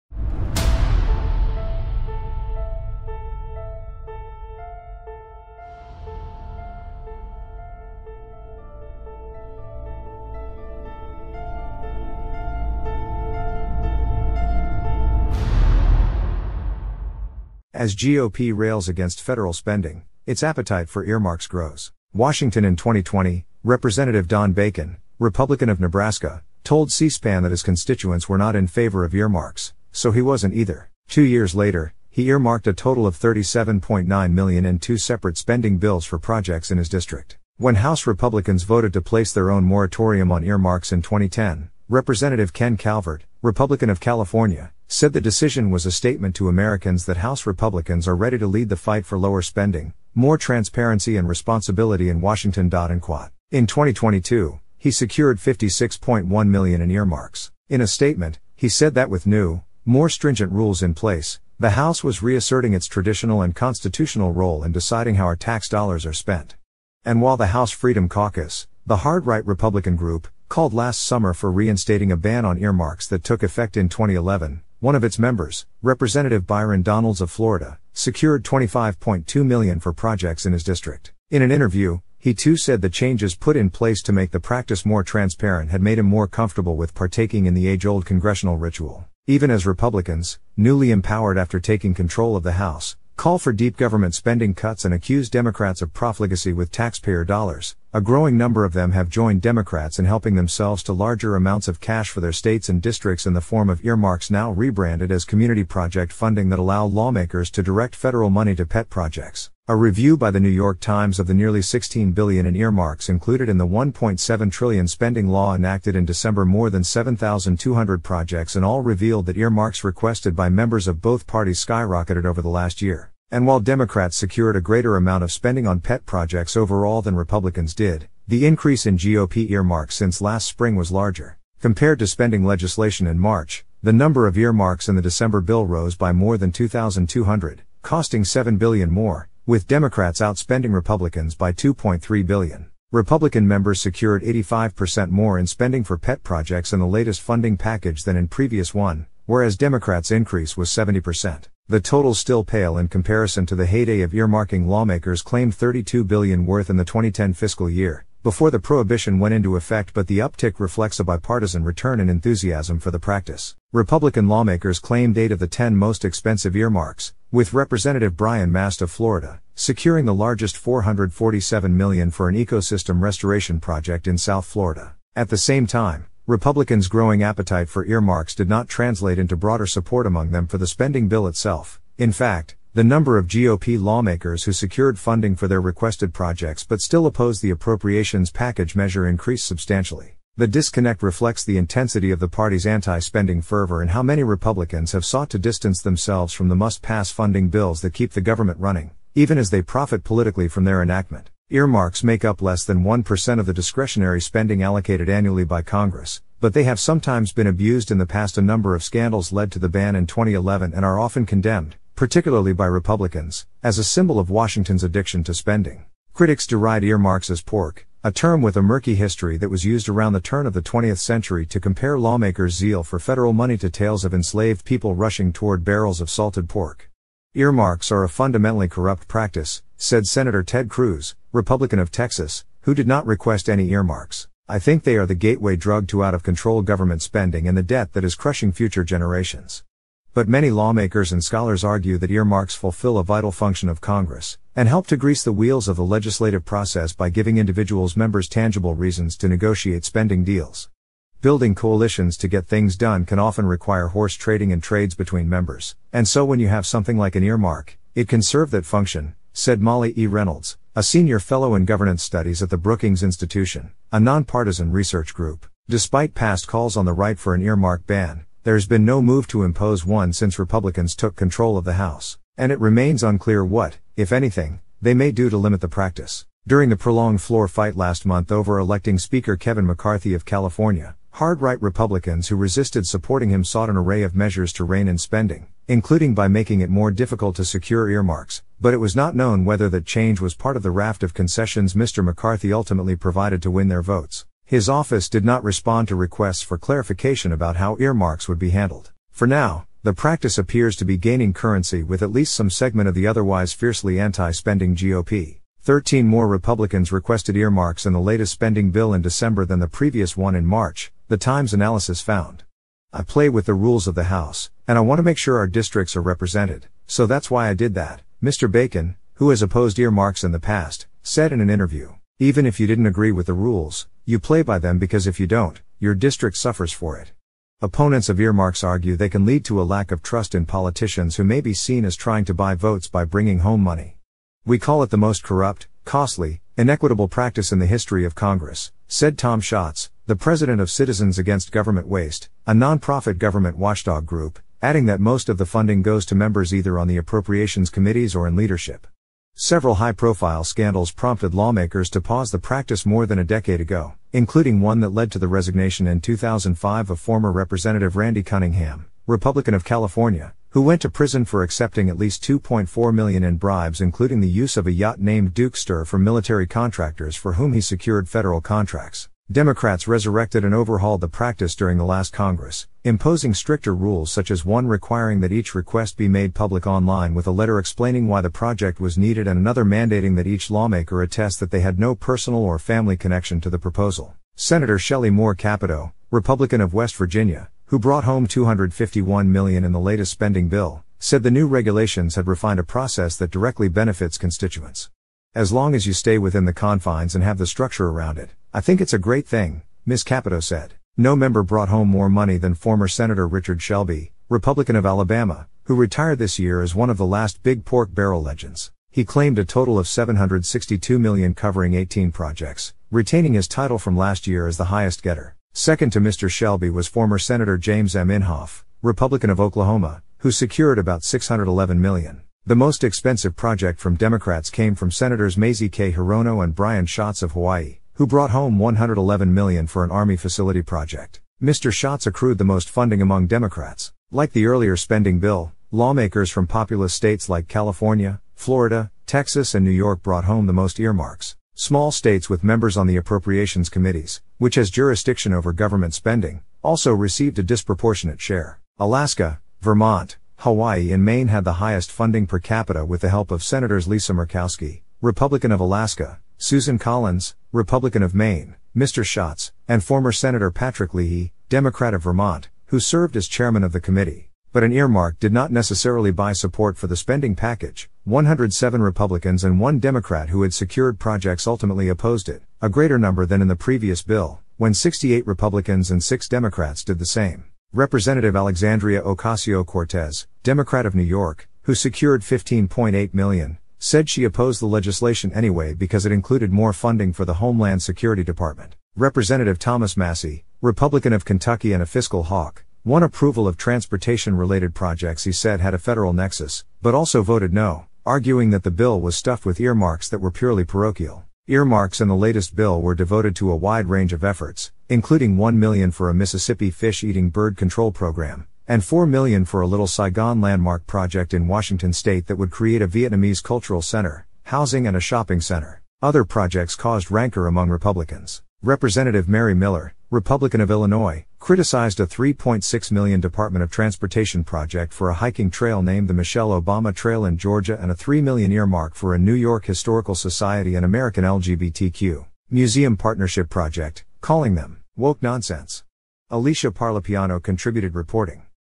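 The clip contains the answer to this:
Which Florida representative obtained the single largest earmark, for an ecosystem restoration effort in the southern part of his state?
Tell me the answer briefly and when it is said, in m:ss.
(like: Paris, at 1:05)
Brian Mast, at 2:48.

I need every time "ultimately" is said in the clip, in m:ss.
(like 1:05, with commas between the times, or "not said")
4:52, 7:51.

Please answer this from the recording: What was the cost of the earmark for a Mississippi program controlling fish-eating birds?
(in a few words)
$1 million.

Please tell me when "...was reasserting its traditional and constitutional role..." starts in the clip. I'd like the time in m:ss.
1:02.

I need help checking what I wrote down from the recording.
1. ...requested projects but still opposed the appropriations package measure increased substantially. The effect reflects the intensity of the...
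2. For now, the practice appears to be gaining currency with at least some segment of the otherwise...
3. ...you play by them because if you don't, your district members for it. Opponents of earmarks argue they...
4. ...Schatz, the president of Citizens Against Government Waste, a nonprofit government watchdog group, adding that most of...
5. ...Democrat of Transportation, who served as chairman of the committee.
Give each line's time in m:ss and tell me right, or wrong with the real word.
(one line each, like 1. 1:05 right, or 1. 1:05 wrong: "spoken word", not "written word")
1. 3:05 wrong: "disconnect", not "effect"
2. 4:59 right
3. 5:24 wrong: "suffers", not "members"
4. 5:39 right
5. 7:41 wrong: "Vermont", not "Transportation".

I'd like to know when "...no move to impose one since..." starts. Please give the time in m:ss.
4:28.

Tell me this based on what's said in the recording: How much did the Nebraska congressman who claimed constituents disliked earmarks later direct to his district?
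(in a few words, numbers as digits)
$37.9 million.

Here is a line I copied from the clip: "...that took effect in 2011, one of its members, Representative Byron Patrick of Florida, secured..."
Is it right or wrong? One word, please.
wrong.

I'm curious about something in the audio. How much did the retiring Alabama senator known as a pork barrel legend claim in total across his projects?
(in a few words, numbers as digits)
$762 million.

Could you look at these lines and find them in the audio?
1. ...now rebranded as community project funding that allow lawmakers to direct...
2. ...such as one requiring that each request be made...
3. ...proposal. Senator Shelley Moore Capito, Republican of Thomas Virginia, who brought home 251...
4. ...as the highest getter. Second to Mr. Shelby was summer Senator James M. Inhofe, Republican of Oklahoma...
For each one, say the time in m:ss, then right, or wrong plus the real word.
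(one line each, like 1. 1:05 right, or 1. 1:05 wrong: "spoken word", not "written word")
1. 1:44 right
2. 6:14 right
3. 6:23 wrong: "West", not "Thomas"
4. 6:54 wrong: "former", not "summer".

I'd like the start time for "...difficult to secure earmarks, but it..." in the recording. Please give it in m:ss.
4:46.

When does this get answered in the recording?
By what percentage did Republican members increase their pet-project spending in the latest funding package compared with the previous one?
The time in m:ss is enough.
2:24.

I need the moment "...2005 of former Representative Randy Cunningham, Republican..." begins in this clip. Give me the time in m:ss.
5:56.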